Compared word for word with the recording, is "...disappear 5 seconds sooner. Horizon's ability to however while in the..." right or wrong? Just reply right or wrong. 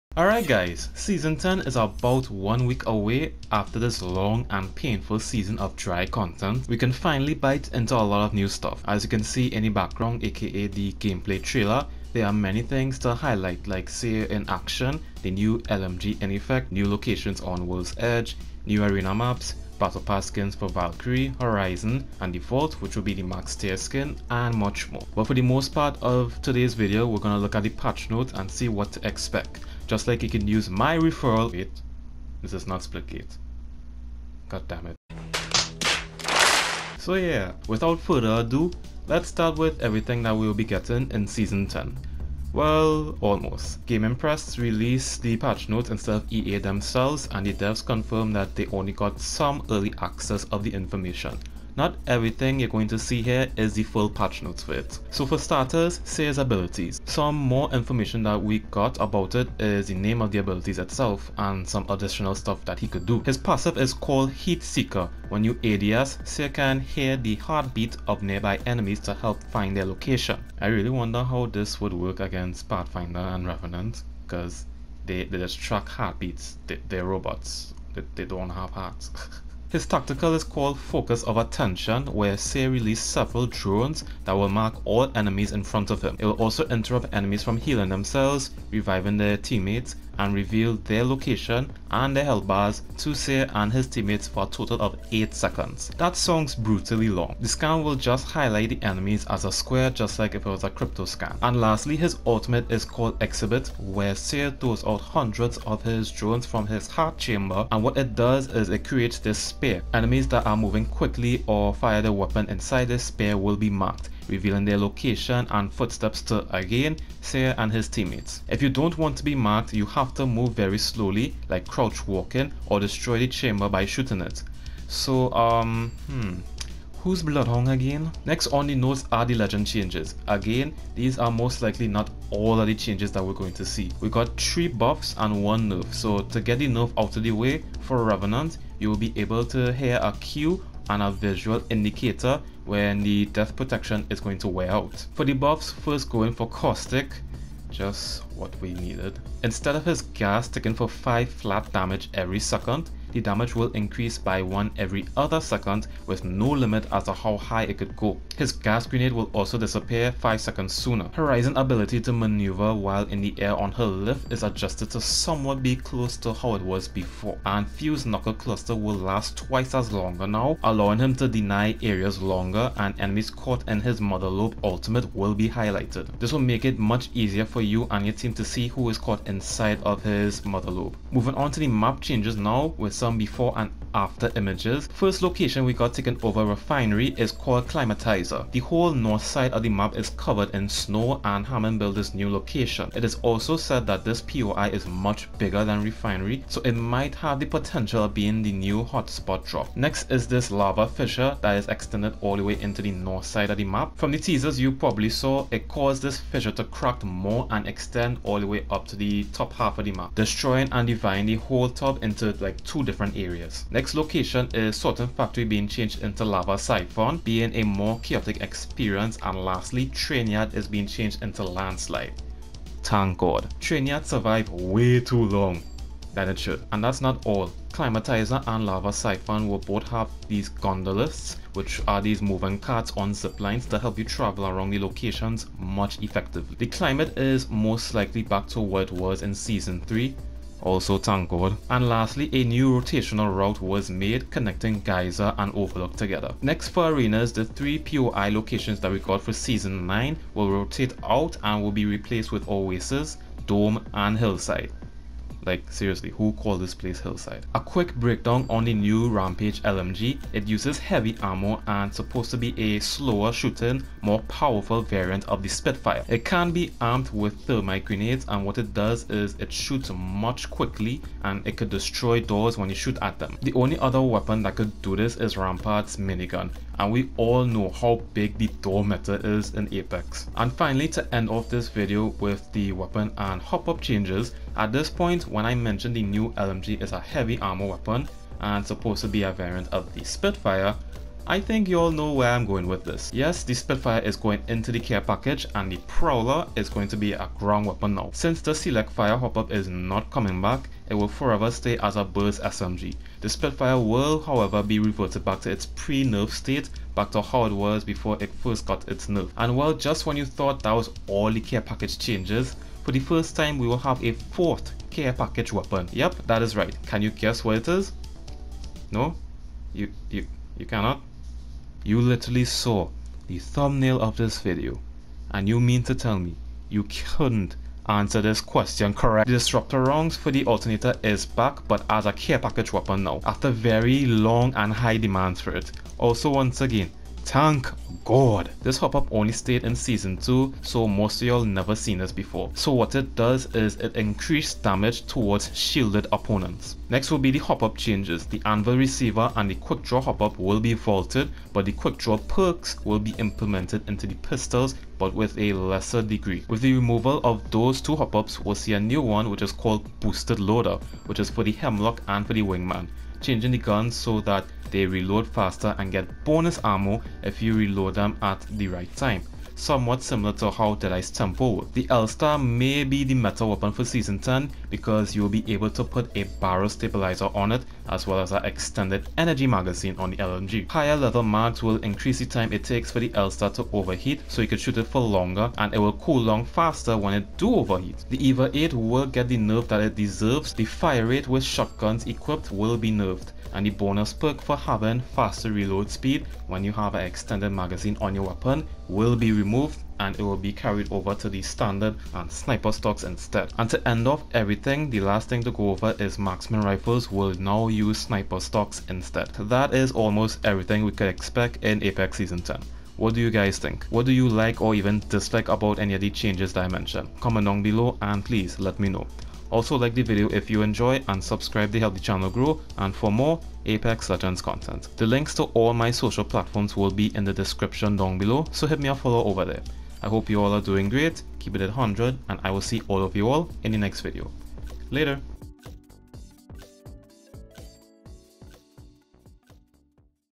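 wrong.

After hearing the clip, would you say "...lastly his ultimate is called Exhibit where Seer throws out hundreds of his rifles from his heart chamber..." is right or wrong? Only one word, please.
wrong.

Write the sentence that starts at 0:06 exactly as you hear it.
We can finally bite into a lot of new stuff.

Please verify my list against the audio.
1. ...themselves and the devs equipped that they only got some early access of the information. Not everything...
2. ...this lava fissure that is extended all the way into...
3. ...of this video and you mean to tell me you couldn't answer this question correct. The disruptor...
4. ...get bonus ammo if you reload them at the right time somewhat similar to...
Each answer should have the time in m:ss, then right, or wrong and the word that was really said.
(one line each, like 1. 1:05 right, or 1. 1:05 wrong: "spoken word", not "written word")
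1. 0:46 wrong: "confirmed", not "equipped"
2. 3:20 right
3. 5:24 right
4. 6:05 right.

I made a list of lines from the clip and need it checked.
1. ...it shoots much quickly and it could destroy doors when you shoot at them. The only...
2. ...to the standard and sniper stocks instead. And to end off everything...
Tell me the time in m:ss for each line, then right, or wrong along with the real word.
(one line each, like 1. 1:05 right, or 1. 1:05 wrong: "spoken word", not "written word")
1. 4:29 right
2. 6:41 right.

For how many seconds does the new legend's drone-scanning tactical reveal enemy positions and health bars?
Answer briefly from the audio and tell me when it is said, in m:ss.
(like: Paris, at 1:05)
8, at 1:35.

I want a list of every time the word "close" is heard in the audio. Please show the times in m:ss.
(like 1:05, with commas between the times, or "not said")
2:45.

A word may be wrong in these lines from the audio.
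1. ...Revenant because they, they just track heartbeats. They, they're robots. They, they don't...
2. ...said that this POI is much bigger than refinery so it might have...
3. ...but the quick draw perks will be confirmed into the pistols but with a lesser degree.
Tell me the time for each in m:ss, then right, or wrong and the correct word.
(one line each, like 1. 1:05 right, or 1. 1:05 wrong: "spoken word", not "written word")
1. 1:13 right
2. 3:13 right
3. 5:51 wrong: "implemented", not "confirmed".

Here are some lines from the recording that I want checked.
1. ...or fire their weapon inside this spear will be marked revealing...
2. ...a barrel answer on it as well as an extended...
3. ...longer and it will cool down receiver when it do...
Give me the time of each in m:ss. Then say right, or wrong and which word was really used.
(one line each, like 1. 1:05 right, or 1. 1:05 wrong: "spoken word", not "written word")
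1. 1:51 right
2. 6:16 wrong: "stabilizer", not "answer"
3. 6:25 wrong: "faster", not "receiver".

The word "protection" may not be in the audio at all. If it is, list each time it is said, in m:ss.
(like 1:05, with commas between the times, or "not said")
2:23.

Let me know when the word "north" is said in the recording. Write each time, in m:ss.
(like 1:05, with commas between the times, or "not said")
3:08, 3:22.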